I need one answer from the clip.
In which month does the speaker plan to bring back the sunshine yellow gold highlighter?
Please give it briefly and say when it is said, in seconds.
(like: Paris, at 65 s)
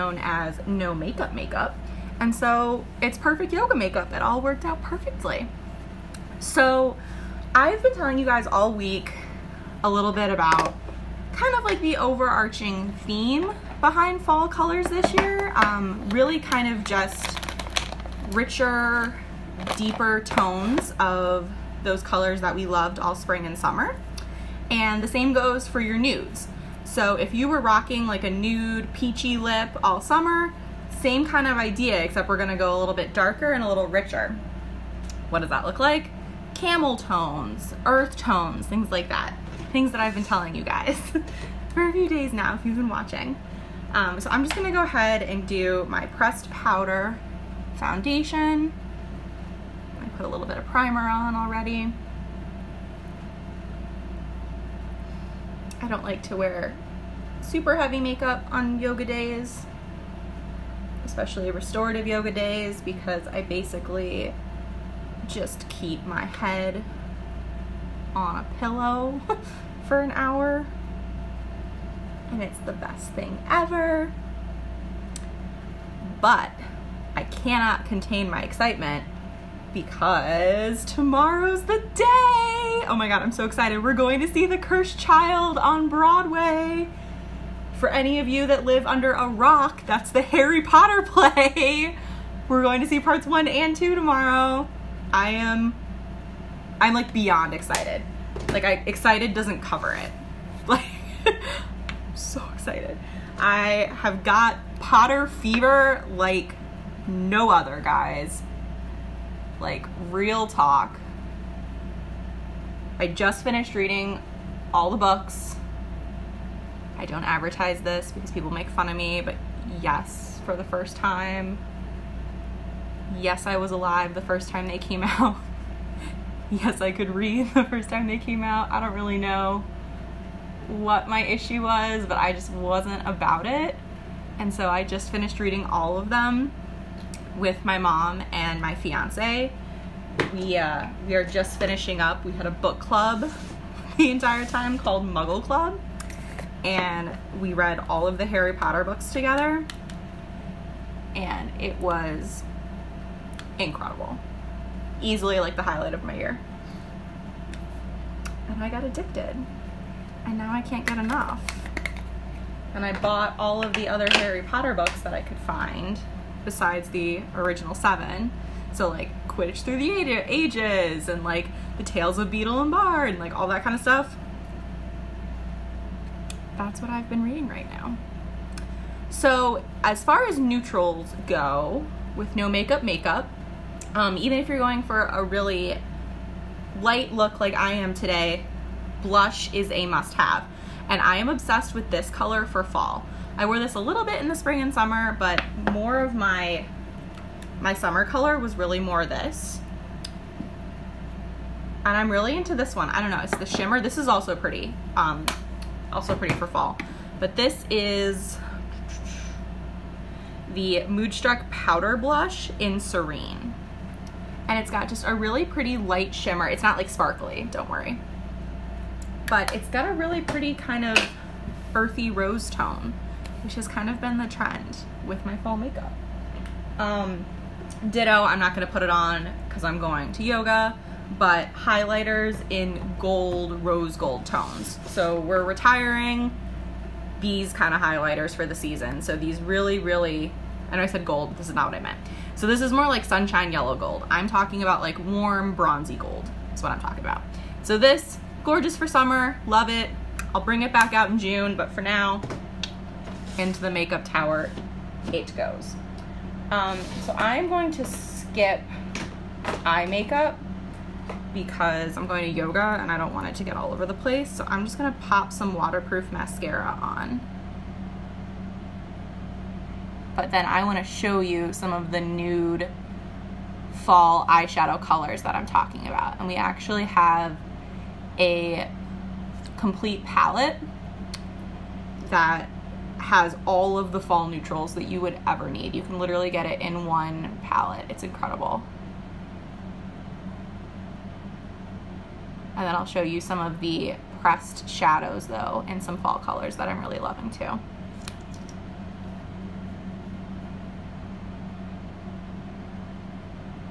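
June, at 251 s.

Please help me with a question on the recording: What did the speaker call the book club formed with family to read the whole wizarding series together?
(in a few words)
Muggle Club.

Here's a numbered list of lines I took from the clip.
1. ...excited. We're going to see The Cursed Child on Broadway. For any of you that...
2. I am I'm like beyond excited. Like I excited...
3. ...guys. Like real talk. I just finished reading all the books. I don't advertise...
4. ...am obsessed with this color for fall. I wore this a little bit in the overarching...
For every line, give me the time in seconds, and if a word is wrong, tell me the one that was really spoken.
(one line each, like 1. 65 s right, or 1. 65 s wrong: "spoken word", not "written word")
1. 83 s right
2. 95 s right
3. 107 s right
4. 191 s wrong: "spring", not "overarching".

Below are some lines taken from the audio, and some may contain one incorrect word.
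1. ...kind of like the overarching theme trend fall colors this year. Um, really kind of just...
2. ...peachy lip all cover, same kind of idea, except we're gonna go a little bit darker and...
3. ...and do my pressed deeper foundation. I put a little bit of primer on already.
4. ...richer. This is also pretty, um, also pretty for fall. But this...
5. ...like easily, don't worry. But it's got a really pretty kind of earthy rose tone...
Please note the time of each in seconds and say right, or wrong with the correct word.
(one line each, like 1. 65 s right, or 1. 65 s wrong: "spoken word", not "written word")
1. 11 s wrong: "behind", not "trend"
2. 28 s wrong: "summer", not "cover"
3. 45 s wrong: "powder", not "deeper"
4. 203 s wrong: "shimmer", not "richer"
5. 216 s wrong: "sparkly", not "easily".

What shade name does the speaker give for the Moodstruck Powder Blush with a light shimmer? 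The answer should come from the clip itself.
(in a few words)
Serene.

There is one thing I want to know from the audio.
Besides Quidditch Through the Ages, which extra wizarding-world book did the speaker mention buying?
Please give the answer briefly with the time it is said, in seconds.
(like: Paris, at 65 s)
Tales of Beedle and Bard, at 171 s.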